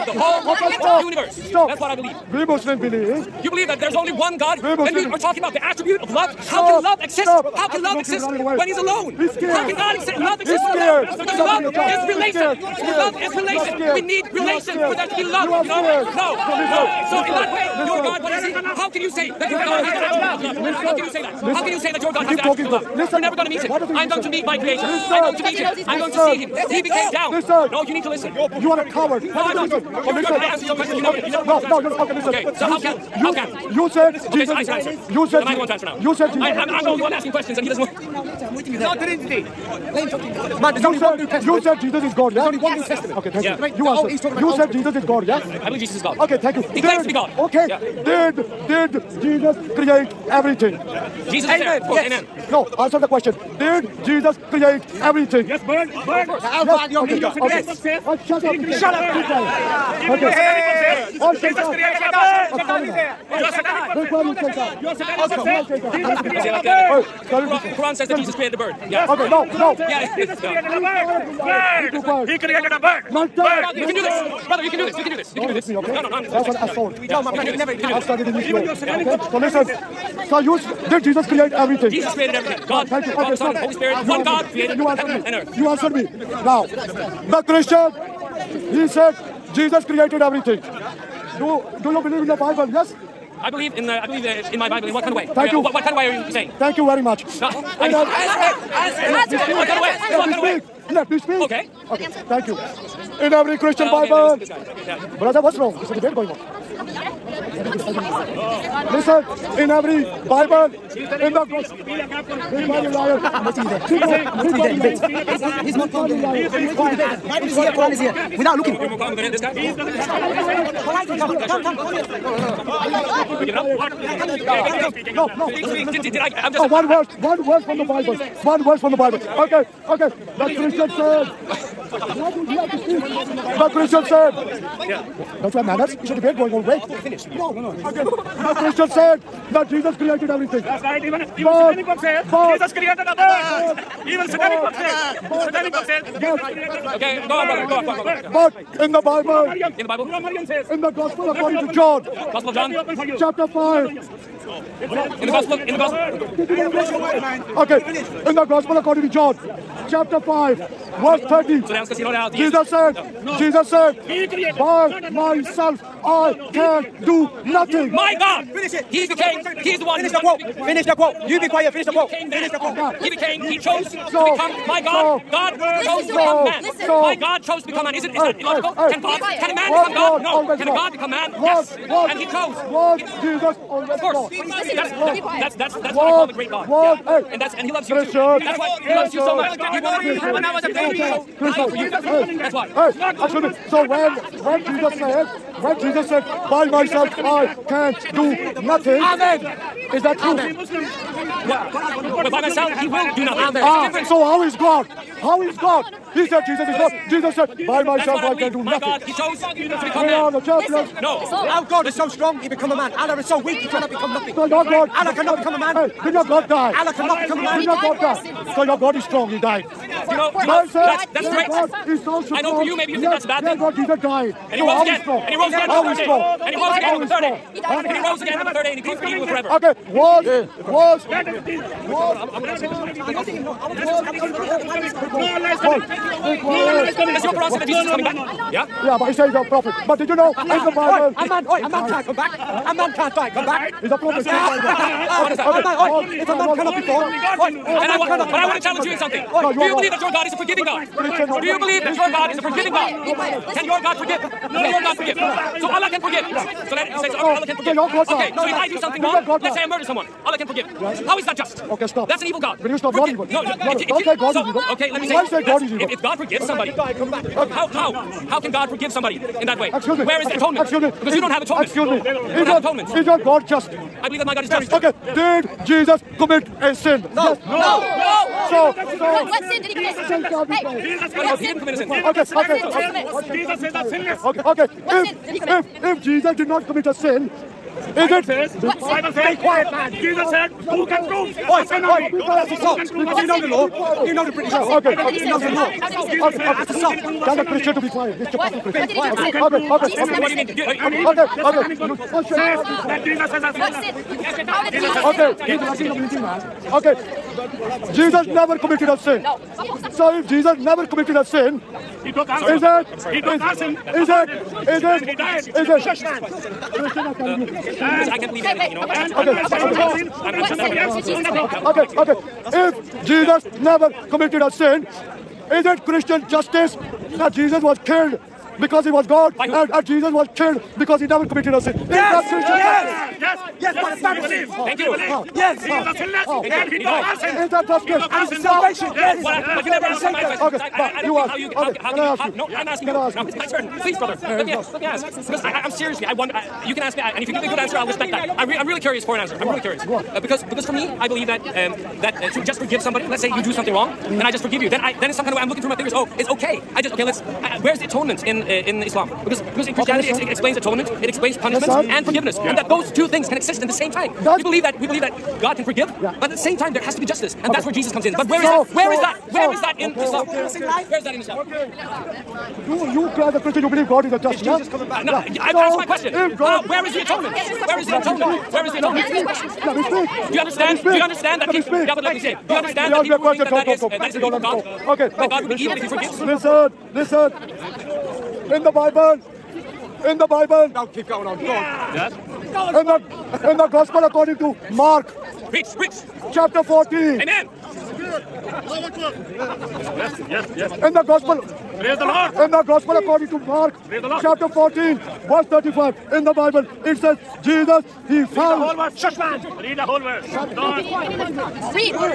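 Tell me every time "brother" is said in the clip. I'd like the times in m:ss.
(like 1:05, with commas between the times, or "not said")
1:14, 1:45, 2:27, 5:43.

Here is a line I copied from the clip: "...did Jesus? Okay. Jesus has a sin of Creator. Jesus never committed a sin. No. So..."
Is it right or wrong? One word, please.
wrong.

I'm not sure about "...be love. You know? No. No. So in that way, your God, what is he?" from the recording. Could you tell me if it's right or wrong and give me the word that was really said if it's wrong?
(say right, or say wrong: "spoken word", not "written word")
right.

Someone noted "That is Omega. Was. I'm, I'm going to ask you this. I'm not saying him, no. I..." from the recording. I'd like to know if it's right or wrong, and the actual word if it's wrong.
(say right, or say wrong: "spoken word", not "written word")
wrong: "Jesus", not "Omega".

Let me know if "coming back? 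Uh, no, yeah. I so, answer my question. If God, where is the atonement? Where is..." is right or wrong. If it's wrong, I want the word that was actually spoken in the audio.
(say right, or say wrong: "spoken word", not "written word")
right.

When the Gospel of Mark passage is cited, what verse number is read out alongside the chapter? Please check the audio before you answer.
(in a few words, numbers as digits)
35.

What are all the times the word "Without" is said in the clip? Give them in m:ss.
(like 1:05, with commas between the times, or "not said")
1:58.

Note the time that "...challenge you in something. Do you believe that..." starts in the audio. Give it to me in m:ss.
4:08.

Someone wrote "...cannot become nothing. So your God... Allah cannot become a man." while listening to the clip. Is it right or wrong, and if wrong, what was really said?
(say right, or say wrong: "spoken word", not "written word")
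right.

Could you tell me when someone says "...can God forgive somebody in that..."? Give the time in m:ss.
4:28.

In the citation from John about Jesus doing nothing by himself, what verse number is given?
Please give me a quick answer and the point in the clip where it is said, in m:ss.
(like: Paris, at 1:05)
30, at 2:40.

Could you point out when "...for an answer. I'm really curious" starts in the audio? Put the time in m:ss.
5:49.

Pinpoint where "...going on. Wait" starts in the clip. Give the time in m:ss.
2:16.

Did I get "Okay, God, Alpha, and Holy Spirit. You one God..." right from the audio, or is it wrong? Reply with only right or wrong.
wrong.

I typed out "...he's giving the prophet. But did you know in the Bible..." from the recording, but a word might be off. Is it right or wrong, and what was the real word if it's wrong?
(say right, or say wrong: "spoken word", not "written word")
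wrong: "saying", not "giving".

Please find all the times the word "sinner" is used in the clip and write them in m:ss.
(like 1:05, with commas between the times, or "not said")
4:41.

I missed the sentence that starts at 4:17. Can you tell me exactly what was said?
Okay, so if I do something wrong, let's say I murder someone.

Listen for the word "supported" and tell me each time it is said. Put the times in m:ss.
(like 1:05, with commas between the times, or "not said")
not said.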